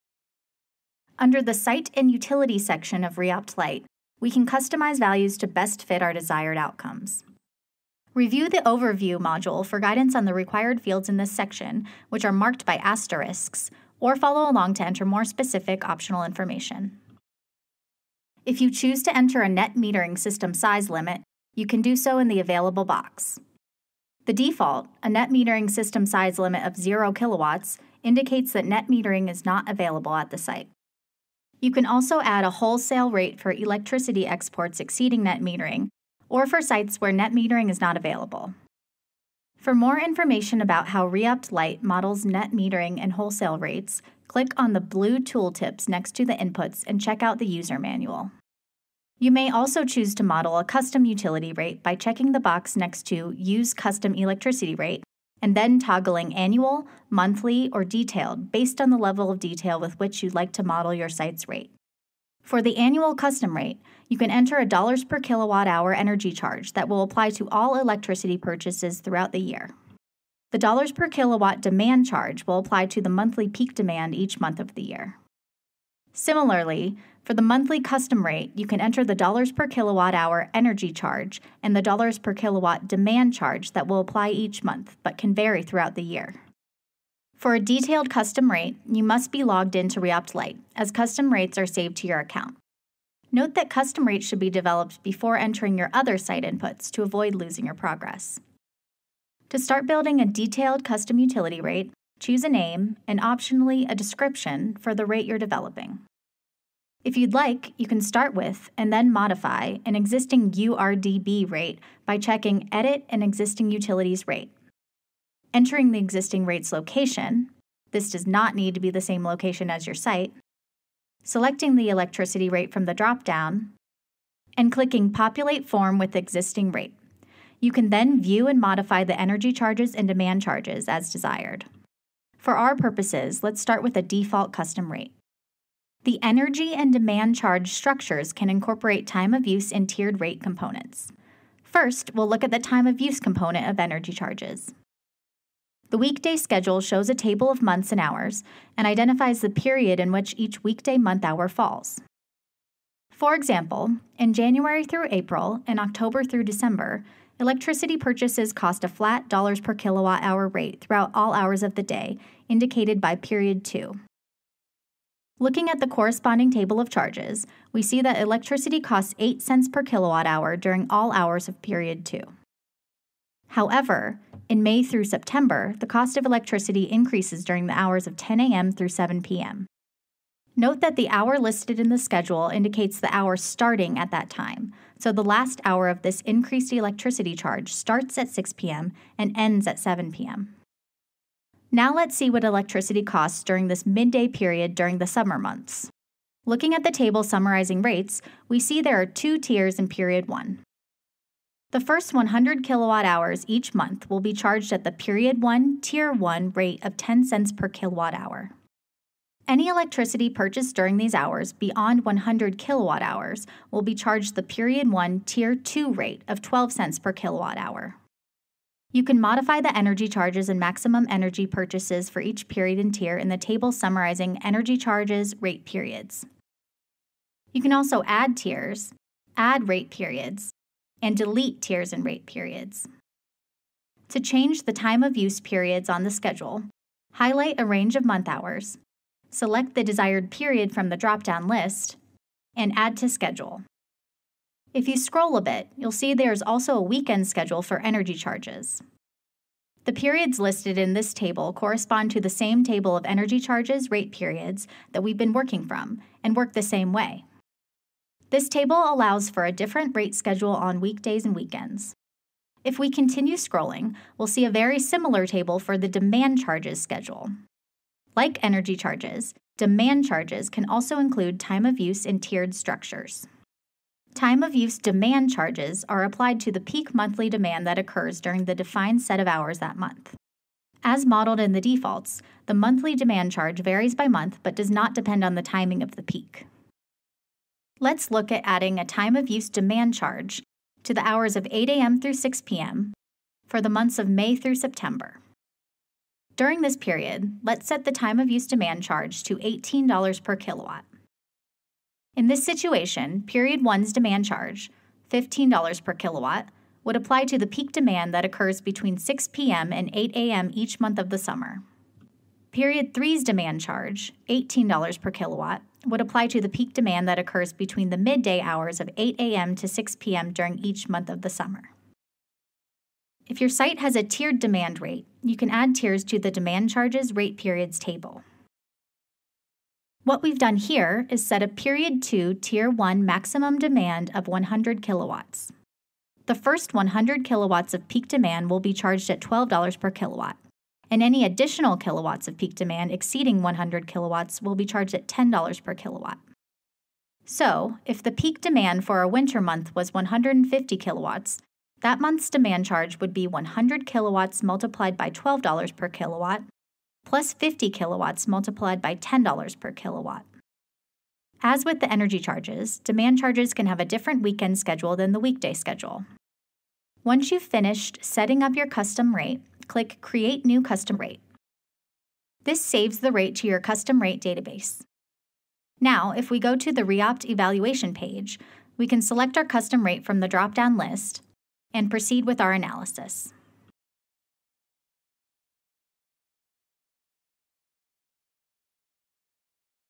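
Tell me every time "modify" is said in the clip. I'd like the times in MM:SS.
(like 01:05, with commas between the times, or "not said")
01:49, 02:08, 03:39.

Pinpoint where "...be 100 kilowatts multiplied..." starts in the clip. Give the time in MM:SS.
05:53.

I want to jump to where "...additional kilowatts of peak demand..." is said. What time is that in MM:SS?
05:41.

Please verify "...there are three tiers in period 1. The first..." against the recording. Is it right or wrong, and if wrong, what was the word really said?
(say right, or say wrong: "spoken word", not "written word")
wrong: "two", not "three".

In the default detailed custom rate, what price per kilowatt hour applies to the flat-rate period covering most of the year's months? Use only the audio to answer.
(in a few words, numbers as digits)
8 cents.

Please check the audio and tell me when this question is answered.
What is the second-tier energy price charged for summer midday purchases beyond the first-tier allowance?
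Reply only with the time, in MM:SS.
03:36.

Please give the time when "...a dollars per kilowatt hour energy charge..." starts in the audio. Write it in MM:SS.
01:04.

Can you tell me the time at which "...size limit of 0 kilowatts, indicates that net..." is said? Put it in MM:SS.
00:26.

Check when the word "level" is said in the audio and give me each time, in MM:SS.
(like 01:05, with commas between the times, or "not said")
00:58.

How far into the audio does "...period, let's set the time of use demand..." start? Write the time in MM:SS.
04:56.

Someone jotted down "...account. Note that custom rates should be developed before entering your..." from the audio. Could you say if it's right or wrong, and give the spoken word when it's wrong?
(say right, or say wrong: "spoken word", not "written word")
right.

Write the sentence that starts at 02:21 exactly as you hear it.
First, we'll look at the time of use component of energy charges.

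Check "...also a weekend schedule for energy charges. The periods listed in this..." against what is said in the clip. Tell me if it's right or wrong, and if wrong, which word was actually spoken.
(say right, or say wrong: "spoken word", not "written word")
right.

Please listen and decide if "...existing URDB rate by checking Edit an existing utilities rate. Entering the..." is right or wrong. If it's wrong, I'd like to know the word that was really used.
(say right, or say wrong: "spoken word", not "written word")
right.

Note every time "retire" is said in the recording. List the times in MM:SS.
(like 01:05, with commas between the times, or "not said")
not said.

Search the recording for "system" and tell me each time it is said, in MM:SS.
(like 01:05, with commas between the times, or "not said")
00:20, 00:25.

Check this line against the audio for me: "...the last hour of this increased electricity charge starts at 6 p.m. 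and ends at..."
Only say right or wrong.
right.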